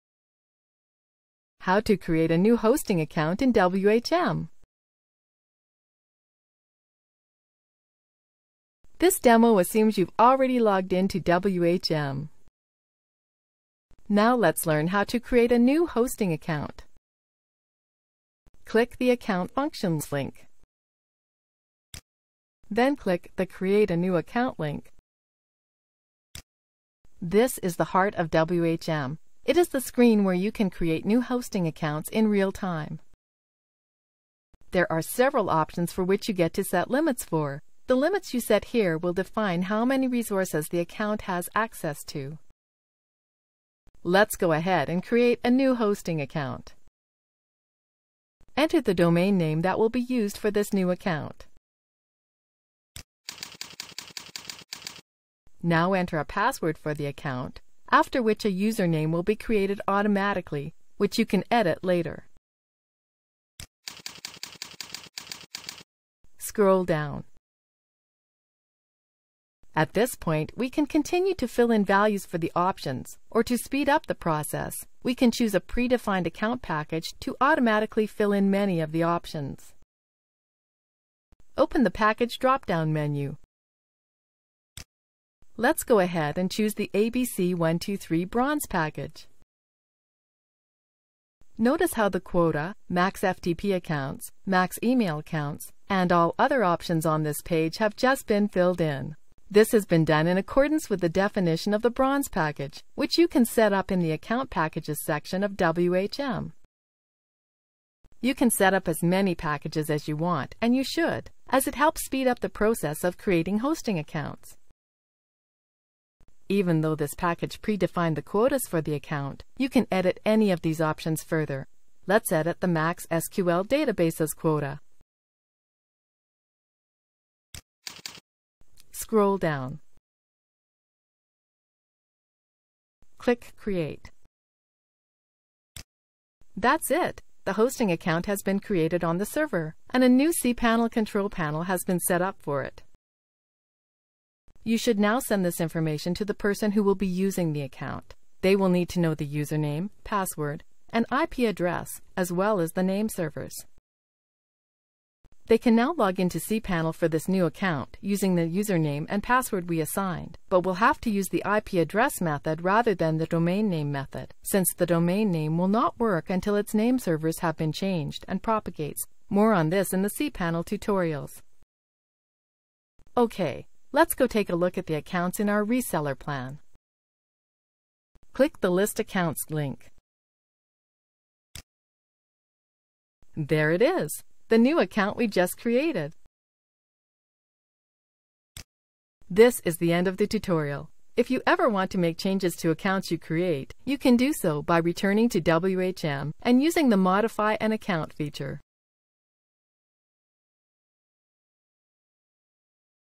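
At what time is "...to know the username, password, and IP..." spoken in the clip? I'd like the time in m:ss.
2:28.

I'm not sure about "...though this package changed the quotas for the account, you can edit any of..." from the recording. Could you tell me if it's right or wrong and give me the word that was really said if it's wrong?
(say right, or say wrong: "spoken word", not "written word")
wrong: "predefined", not "changed".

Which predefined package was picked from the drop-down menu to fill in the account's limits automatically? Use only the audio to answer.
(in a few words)
ABC123 Bronze.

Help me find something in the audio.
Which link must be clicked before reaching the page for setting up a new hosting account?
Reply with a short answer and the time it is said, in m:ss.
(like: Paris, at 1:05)
Account Functions, at 0:19.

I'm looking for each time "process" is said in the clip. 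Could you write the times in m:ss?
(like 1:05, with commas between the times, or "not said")
1:14, 1:52.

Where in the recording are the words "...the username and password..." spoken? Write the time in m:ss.
2:38.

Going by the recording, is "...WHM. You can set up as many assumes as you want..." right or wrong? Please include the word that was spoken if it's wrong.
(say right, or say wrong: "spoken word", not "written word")
wrong: "packages", not "assumes".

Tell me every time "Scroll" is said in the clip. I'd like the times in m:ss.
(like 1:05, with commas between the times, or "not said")
1:06, 2:08.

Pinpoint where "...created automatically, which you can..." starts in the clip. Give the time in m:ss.
0:59.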